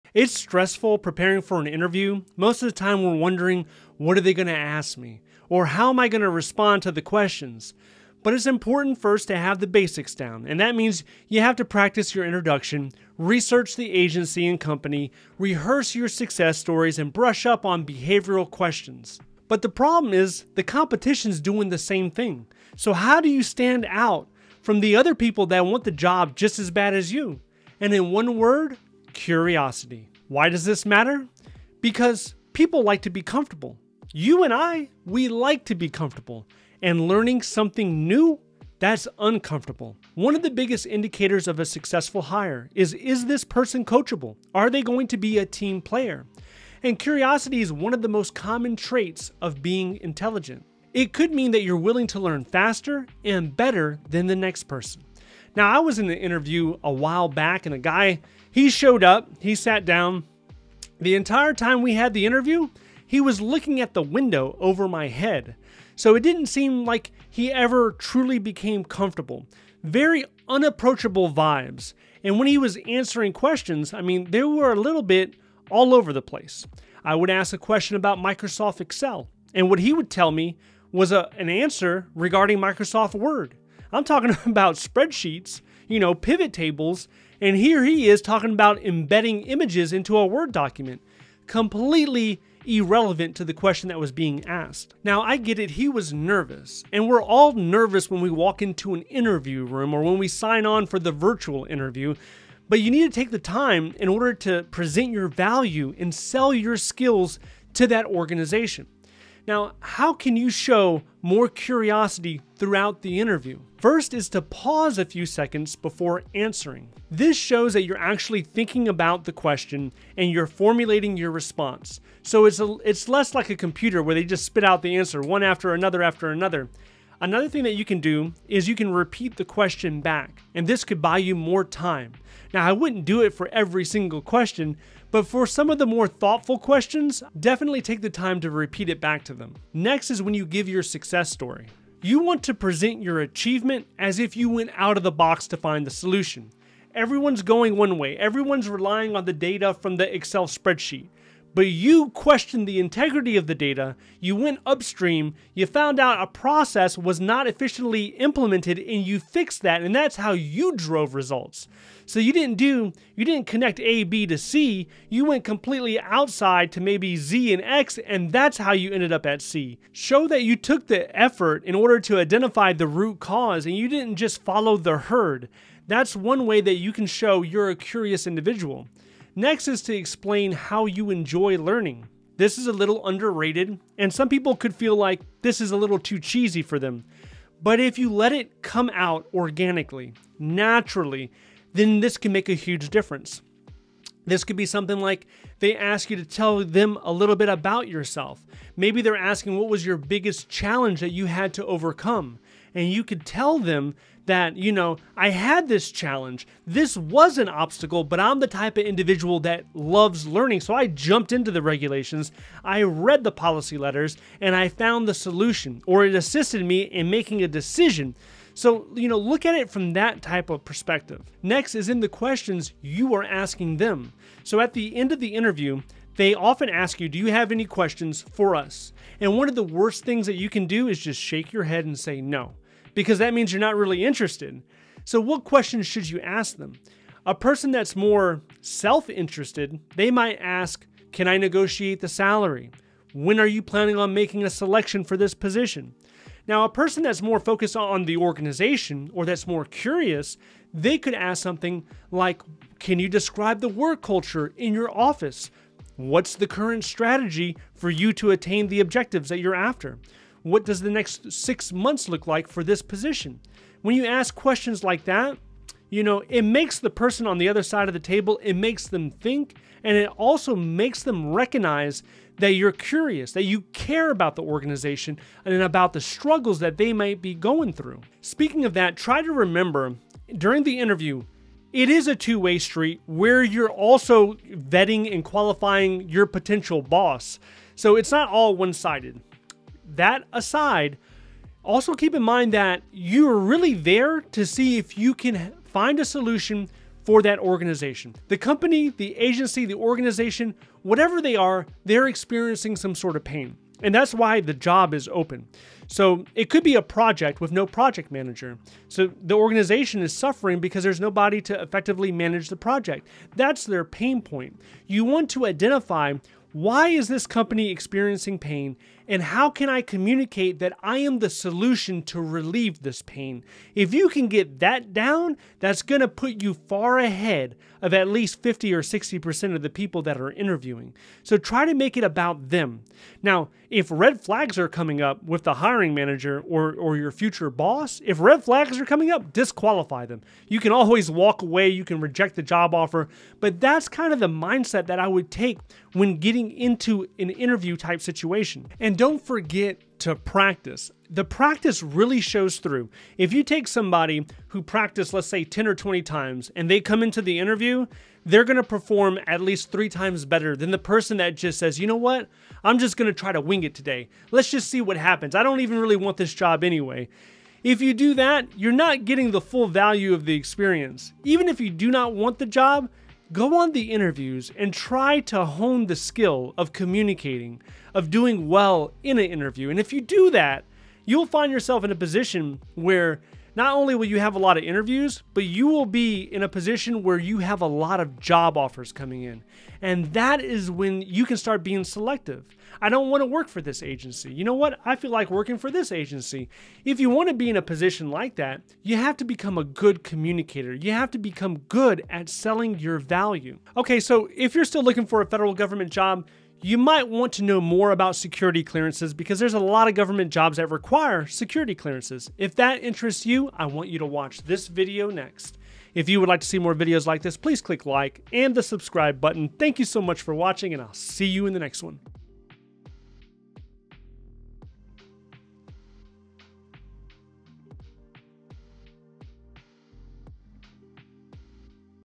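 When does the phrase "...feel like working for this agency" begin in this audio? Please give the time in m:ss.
6:34.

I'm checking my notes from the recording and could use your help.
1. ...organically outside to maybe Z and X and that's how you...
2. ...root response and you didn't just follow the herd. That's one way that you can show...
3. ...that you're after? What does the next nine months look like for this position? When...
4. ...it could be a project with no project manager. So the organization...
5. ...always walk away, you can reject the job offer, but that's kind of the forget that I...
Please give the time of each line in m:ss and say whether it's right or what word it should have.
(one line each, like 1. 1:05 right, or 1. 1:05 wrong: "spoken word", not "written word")
1. 2:45 wrong: "completely", not "organically"
2. 2:52 wrong: "cause", not "response"
3. 4:19 wrong: "six", not "nine"
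4. 5:06 right
5. 5:40 wrong: "mindset", not "forget".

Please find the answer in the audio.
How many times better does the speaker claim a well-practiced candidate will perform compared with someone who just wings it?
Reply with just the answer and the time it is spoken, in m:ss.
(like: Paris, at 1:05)
3, at 5:59.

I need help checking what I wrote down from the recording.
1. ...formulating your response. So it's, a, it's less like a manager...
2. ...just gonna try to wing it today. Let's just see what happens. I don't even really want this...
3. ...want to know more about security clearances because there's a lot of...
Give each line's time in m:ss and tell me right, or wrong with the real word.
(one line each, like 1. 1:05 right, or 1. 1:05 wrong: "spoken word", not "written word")
1. 2:00 wrong: "computer", not "manager"
2. 6:02 right
3. 6:47 right.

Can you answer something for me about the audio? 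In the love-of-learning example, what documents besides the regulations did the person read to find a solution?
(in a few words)
Policy letters.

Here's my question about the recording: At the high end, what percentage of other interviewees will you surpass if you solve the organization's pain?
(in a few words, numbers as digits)
60%.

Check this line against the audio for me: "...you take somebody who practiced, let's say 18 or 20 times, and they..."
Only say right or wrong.
wrong.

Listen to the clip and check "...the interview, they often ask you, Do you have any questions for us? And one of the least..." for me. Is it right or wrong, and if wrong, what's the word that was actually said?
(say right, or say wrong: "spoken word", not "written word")
wrong: "worst", not "least".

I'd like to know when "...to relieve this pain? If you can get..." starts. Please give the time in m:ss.
5:22.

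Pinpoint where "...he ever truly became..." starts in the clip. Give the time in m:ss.
1:07.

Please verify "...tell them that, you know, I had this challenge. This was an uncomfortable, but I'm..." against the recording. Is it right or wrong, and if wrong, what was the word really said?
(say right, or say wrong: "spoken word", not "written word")
wrong: "obstacle", not "uncomfortable".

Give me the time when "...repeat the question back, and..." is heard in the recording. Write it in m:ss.
2:08.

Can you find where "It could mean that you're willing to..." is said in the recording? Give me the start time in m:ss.
0:50.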